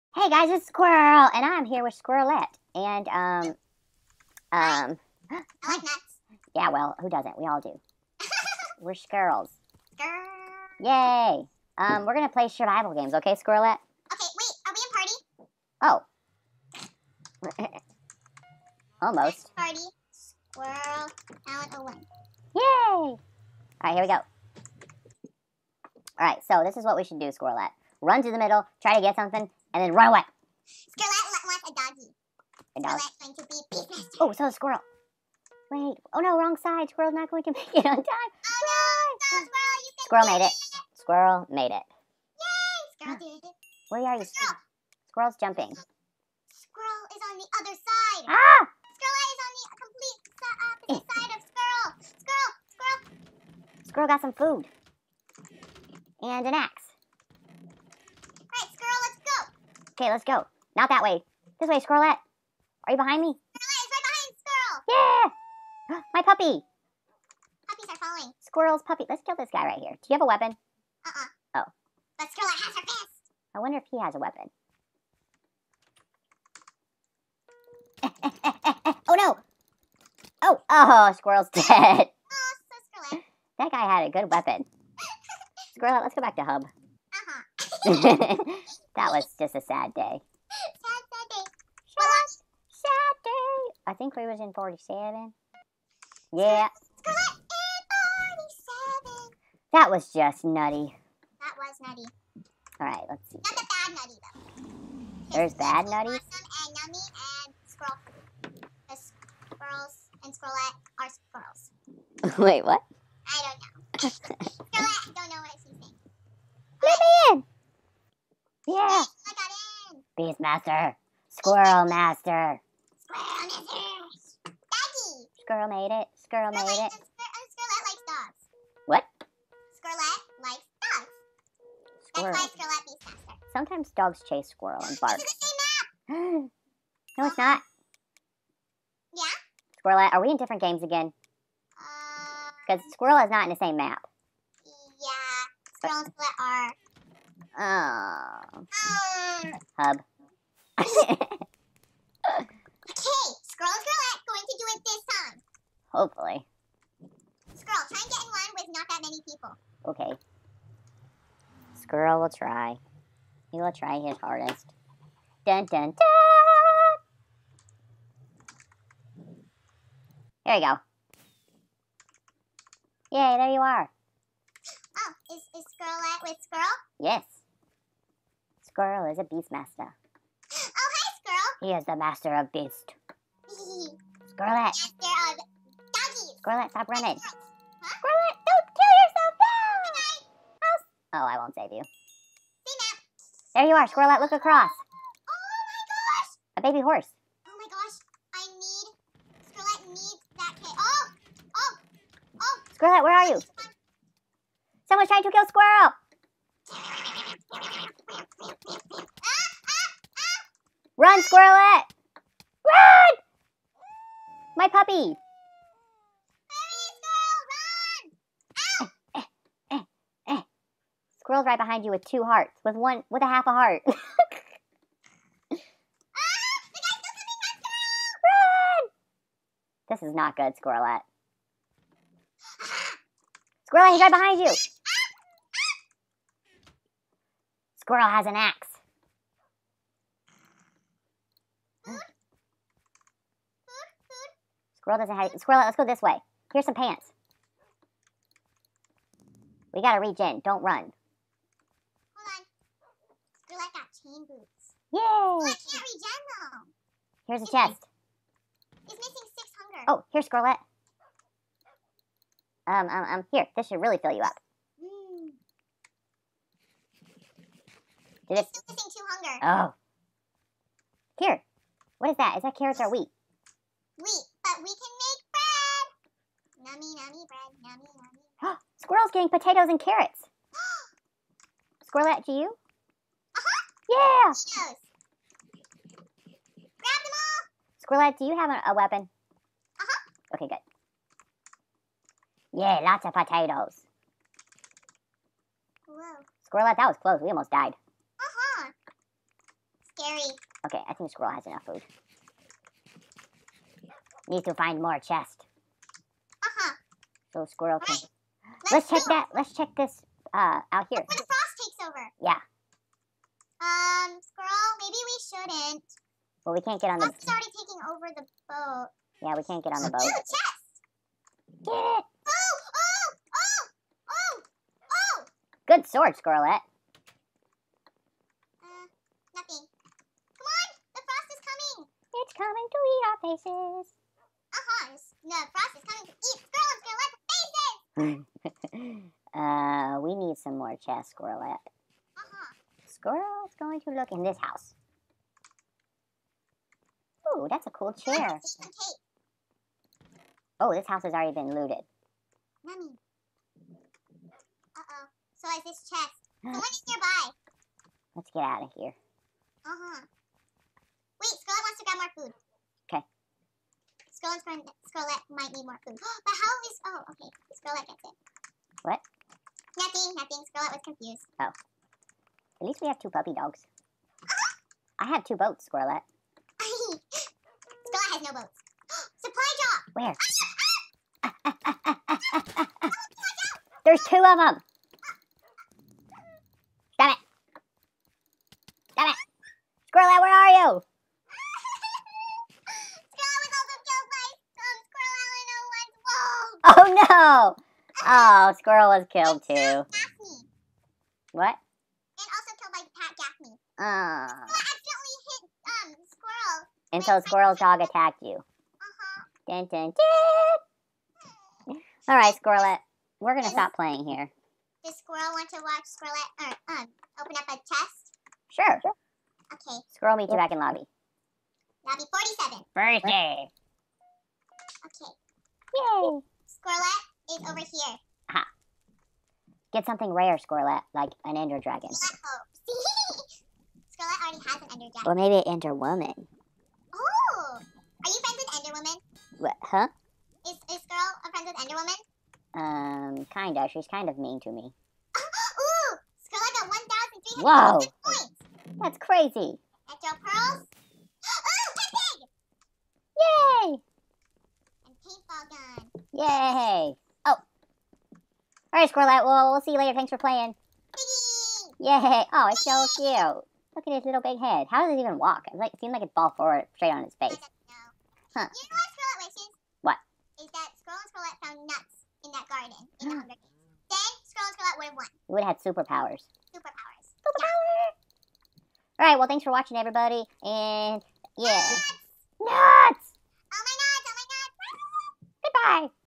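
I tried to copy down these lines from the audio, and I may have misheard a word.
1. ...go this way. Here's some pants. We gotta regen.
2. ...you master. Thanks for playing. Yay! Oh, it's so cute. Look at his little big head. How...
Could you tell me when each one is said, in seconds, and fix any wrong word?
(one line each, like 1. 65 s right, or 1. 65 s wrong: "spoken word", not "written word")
1. 245 s right
2. 459 s wrong: "later", not "master".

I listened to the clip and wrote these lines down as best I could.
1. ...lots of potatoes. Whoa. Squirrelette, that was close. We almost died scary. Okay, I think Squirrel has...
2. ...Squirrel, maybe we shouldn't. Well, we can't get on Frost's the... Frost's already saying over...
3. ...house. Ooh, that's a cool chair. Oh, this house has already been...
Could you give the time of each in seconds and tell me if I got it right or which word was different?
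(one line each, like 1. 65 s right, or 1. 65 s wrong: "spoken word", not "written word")
1. 292 s right
2. 314 s wrong: "taking", not "saying"
3. 344 s right.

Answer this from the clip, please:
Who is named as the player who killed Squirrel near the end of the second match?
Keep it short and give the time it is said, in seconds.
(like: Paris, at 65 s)
Pat Gaffney, at 402 s.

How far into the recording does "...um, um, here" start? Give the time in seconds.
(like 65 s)
262 s.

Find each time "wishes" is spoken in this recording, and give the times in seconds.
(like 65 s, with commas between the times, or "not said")
469 s.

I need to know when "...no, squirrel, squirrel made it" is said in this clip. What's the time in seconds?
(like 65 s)
39 s.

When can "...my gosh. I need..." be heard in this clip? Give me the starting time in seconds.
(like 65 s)
197 s.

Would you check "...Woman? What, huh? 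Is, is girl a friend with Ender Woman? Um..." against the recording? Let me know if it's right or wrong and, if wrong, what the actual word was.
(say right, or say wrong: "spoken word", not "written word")
right.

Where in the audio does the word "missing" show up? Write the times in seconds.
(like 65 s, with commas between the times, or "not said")
258 s, 268 s.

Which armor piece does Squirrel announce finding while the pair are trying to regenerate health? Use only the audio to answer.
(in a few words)
Chain boots.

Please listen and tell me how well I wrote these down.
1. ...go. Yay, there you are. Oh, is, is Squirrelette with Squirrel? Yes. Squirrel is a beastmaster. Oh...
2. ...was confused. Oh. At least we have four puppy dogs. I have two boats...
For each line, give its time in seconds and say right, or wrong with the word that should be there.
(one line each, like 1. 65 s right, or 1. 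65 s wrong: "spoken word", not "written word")
1. 170 s right
2. 370 s wrong: "two", not "four".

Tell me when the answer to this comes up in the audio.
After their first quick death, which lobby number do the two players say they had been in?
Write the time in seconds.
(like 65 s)
94 s.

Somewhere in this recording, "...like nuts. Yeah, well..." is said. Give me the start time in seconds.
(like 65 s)
5 s.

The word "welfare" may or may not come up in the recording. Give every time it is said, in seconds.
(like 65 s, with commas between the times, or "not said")
not said.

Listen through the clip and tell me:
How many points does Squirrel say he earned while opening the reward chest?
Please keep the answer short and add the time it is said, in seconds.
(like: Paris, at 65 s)
1,300, at 447 s.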